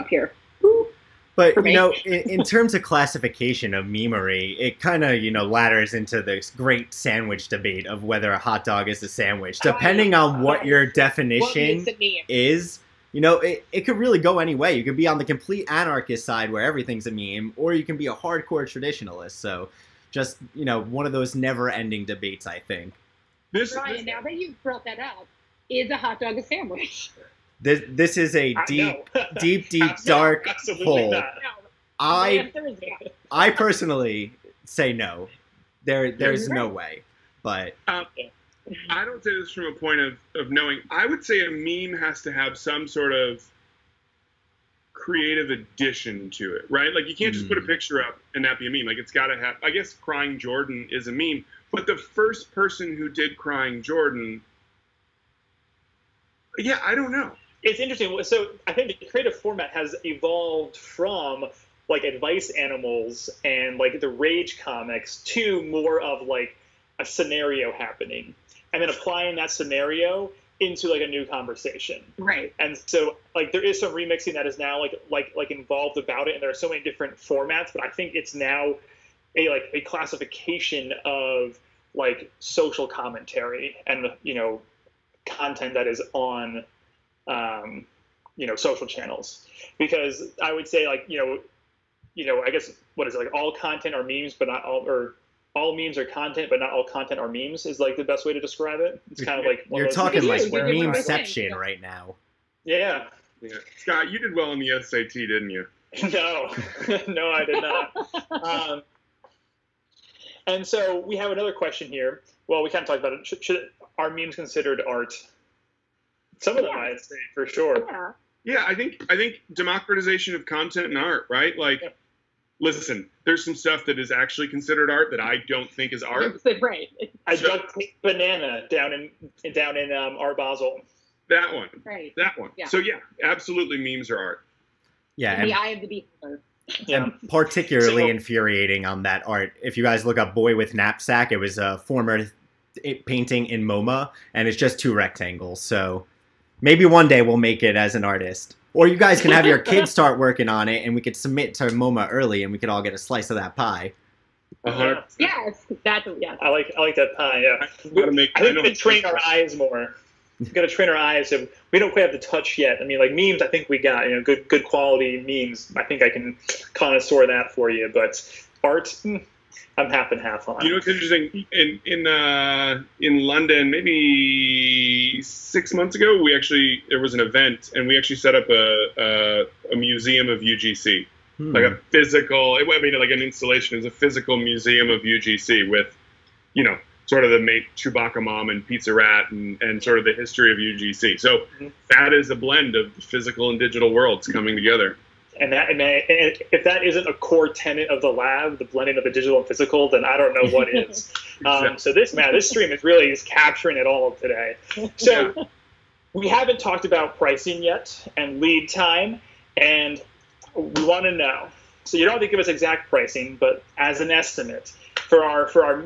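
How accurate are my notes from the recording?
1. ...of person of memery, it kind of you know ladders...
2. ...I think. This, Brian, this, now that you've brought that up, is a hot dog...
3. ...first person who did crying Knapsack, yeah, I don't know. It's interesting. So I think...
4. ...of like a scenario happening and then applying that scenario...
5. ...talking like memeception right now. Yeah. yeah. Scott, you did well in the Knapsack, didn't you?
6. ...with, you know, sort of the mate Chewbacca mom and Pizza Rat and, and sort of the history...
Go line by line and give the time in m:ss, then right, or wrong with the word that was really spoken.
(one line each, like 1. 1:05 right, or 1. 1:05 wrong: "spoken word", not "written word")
1. 0:02 wrong: "classification", not "person"
2. 0:22 right
3. 0:51 wrong: "Jordan", not "Knapsack"
4. 1:05 right
5. 1:39 wrong: "SAT", not "Knapsack"
6. 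3:05 right.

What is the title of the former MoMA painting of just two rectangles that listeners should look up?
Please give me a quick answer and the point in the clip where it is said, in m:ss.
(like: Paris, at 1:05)
Boy with Knapsack, at 2:20.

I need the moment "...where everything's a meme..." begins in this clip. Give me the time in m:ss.
0:16.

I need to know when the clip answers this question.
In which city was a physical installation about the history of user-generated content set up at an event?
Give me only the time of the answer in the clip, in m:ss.
2:53.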